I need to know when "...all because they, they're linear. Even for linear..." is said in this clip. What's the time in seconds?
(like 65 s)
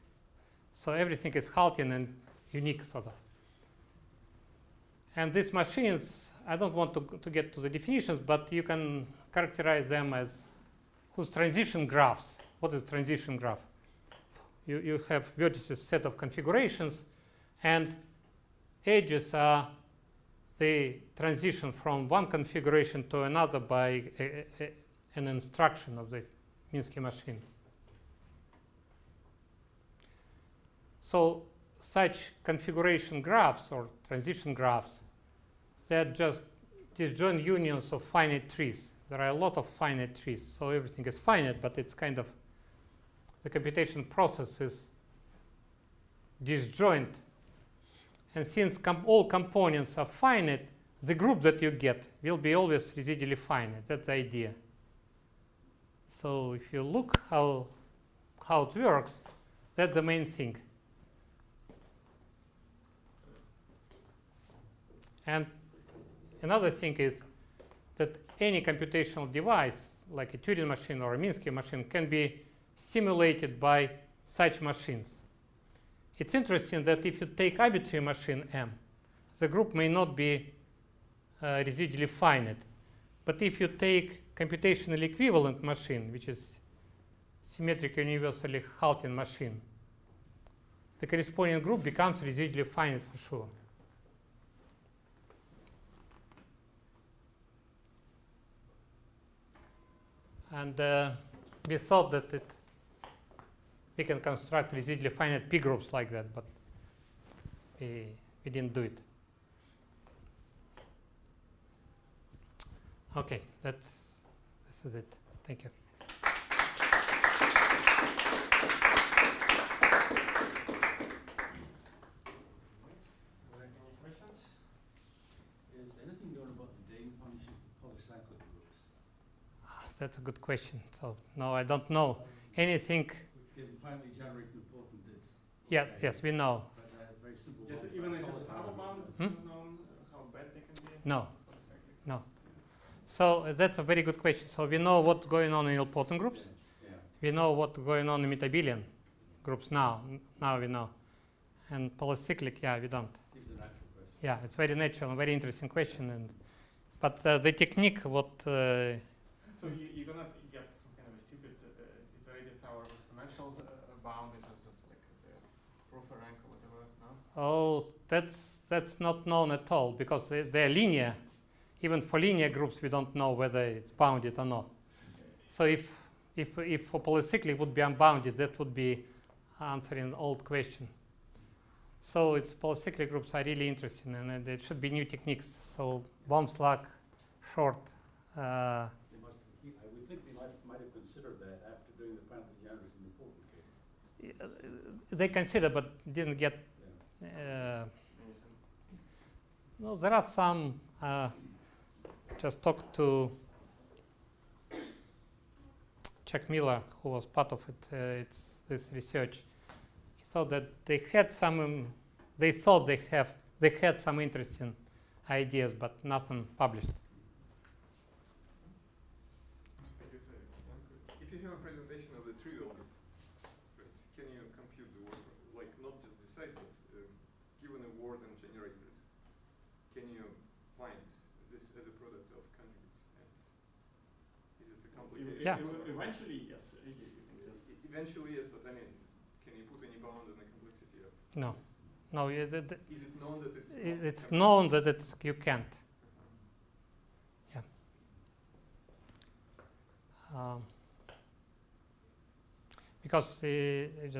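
169 s.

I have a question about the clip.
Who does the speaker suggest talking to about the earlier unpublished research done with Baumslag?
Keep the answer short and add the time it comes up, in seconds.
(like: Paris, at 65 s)
Chuck Miller, at 206 s.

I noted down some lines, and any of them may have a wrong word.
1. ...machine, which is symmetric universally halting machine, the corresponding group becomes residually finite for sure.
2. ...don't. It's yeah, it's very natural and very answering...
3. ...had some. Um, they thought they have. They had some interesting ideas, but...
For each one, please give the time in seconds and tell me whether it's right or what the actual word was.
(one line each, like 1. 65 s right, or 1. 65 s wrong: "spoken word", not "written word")
1. 85 s right
2. 152 s wrong: "interesting", not "answering"
3. 211 s right.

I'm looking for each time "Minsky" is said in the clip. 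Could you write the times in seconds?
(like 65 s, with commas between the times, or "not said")
26 s, 71 s.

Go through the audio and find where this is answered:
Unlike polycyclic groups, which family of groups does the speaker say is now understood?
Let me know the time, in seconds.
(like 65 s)
148 s.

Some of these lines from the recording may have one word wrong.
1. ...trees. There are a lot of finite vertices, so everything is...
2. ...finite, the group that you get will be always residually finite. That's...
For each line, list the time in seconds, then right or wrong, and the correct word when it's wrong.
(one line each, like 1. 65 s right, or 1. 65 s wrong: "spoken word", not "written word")
1. 38 s wrong: "trees", not "vertices"
2. 50 s right.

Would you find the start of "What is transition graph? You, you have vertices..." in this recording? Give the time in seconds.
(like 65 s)
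12 s.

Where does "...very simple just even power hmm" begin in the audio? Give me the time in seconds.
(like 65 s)
137 s.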